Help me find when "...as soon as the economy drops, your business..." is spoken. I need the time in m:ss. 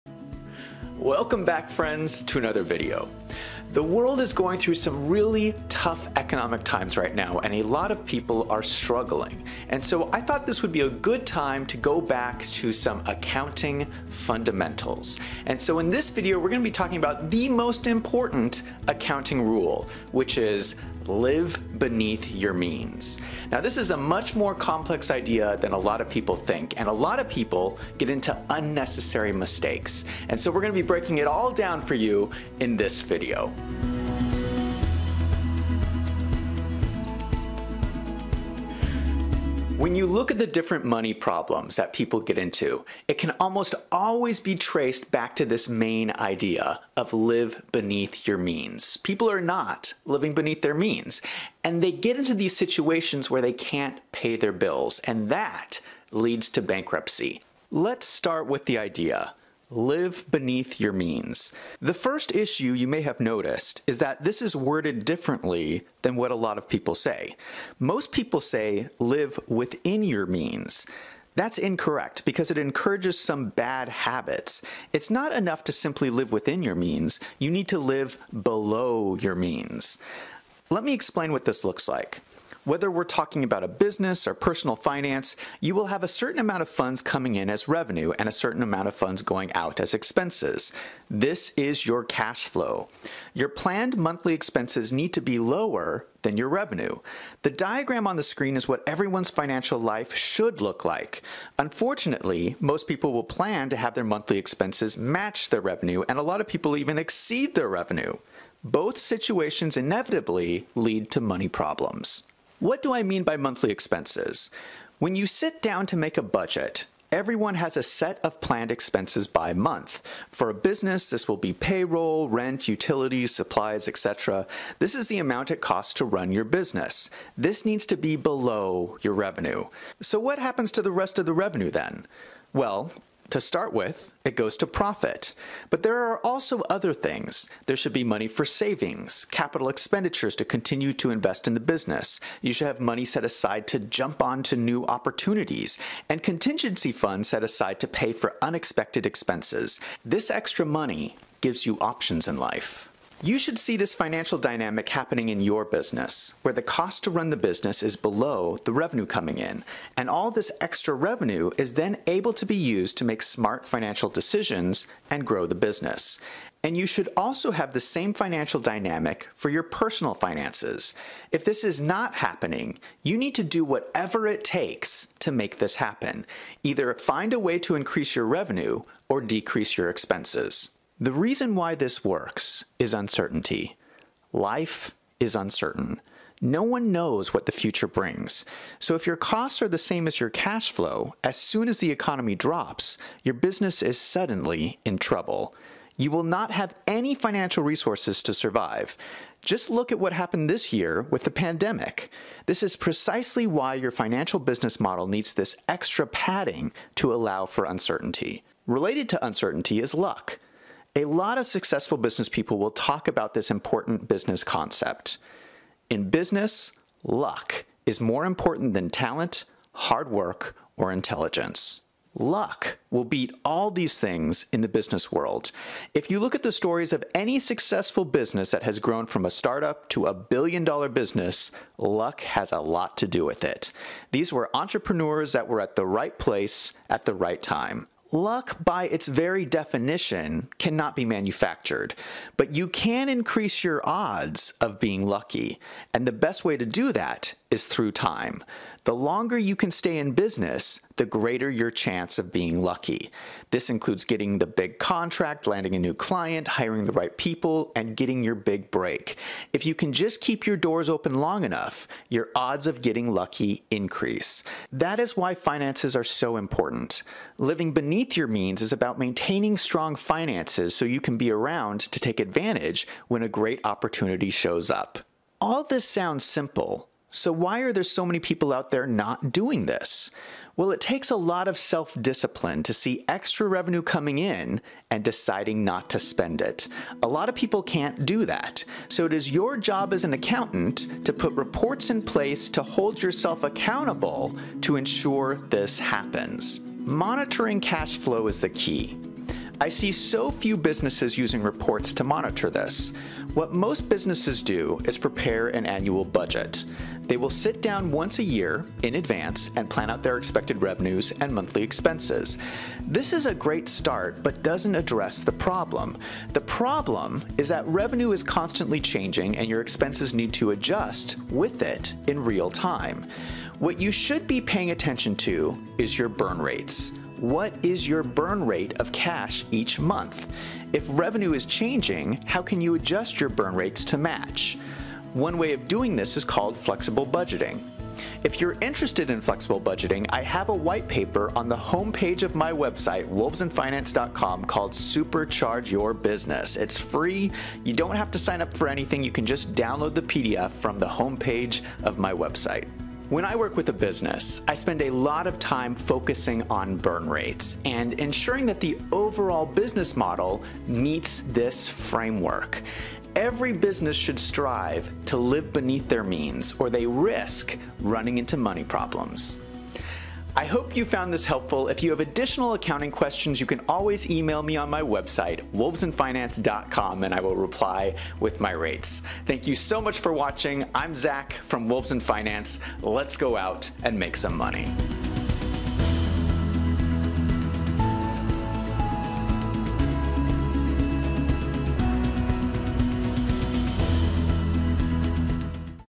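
3:11.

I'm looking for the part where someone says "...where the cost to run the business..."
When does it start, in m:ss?
2:36.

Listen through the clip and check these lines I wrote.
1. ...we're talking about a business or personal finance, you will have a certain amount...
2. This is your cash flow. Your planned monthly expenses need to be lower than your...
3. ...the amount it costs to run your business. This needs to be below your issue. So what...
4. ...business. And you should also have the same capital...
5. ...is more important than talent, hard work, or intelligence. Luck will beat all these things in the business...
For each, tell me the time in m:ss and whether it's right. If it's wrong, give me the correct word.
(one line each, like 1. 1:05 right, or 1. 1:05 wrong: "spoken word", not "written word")
1. 1:22 right
2. 1:31 right
3. 2:05 wrong: "revenue", not "issue"
4. 2:45 wrong: "financial", not "capital"
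5. 3:37 right.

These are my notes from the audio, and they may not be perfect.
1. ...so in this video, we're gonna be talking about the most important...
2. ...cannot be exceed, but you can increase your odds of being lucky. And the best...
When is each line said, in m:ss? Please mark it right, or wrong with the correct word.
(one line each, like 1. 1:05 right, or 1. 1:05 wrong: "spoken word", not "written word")
1. 0:15 right
2. 4:00 wrong: "manufactured", not "exceed".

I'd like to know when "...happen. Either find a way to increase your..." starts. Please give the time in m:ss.
2:55.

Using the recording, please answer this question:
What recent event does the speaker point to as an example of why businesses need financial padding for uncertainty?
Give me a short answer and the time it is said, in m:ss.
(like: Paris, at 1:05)
the pandemic, at 3:21.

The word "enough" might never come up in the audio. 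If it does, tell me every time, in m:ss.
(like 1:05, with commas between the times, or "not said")
1:15, 4:21.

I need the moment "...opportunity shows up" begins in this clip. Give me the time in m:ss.
4:33.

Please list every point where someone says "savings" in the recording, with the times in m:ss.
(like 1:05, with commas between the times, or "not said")
2:18.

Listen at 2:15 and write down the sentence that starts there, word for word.
But there are also other things.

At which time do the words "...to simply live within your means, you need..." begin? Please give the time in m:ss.
1:15.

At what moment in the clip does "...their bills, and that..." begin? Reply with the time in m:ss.
0:54.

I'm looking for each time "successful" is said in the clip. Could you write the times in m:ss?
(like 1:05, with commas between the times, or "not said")
3:31, 3:47.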